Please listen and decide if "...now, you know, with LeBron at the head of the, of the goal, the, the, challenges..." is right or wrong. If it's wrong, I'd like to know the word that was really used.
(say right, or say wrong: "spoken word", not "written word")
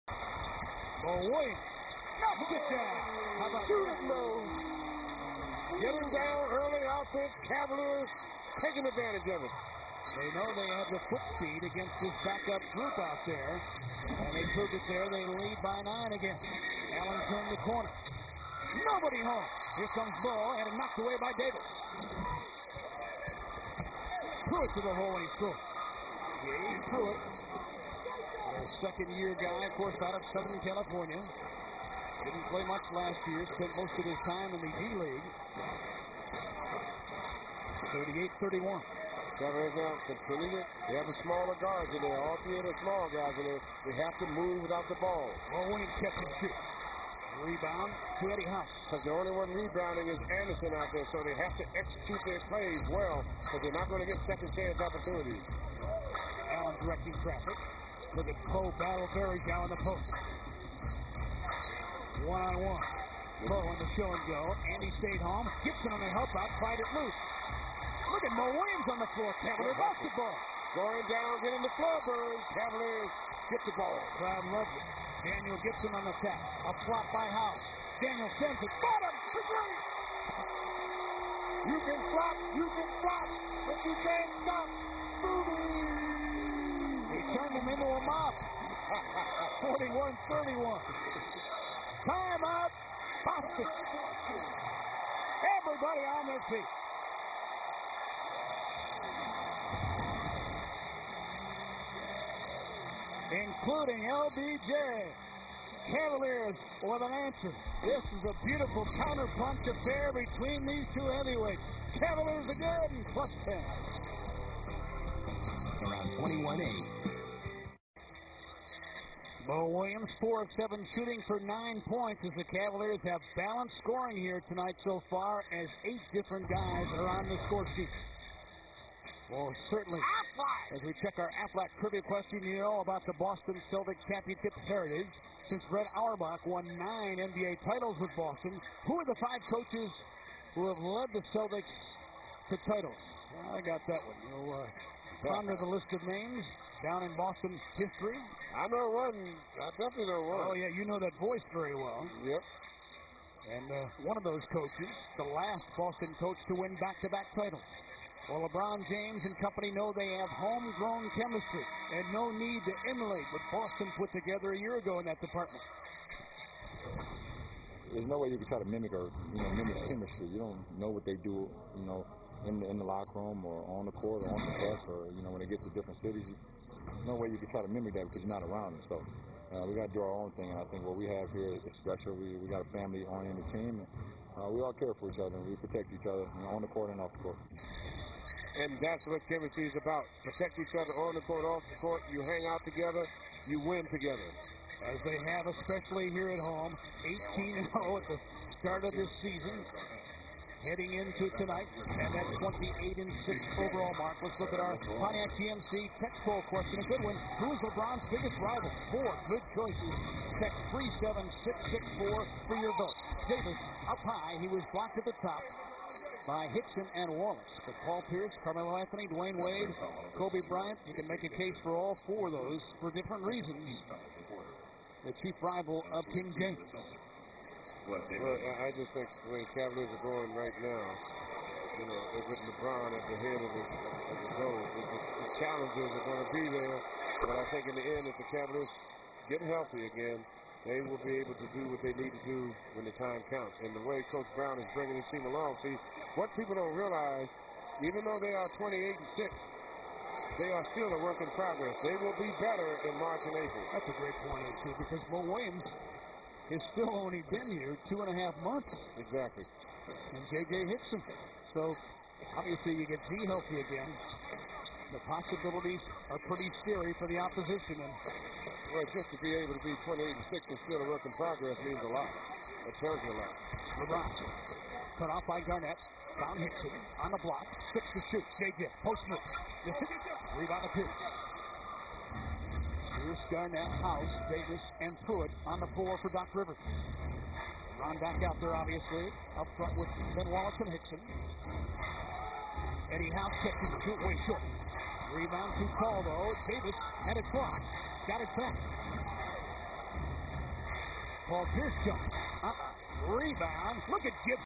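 right.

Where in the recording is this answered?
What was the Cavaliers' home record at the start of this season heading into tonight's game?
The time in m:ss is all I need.
3:17.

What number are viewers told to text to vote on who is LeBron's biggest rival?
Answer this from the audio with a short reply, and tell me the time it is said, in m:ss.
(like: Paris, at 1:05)
37664, at 3:30.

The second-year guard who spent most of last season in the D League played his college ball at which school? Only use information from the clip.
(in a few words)
Southern California.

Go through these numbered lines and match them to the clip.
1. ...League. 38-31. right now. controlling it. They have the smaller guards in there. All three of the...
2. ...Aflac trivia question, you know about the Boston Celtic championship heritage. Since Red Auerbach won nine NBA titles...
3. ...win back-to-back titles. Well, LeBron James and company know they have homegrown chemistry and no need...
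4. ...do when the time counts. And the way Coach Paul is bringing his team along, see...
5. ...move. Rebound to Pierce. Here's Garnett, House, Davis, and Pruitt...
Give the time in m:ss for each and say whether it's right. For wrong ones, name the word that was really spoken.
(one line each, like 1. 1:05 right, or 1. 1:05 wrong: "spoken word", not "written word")
1. 0:34 right
2. 2:11 right
3. 2:36 right
4. 4:02 wrong: "Brown", not "Paul"
5. 4:39 right.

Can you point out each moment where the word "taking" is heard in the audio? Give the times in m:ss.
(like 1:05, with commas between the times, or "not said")
0:08.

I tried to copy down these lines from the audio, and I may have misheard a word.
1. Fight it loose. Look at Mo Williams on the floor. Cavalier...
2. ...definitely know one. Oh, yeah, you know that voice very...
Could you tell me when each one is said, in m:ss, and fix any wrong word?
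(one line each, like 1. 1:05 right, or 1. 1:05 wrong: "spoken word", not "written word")
1. 1:06 right
2. 2:29 right.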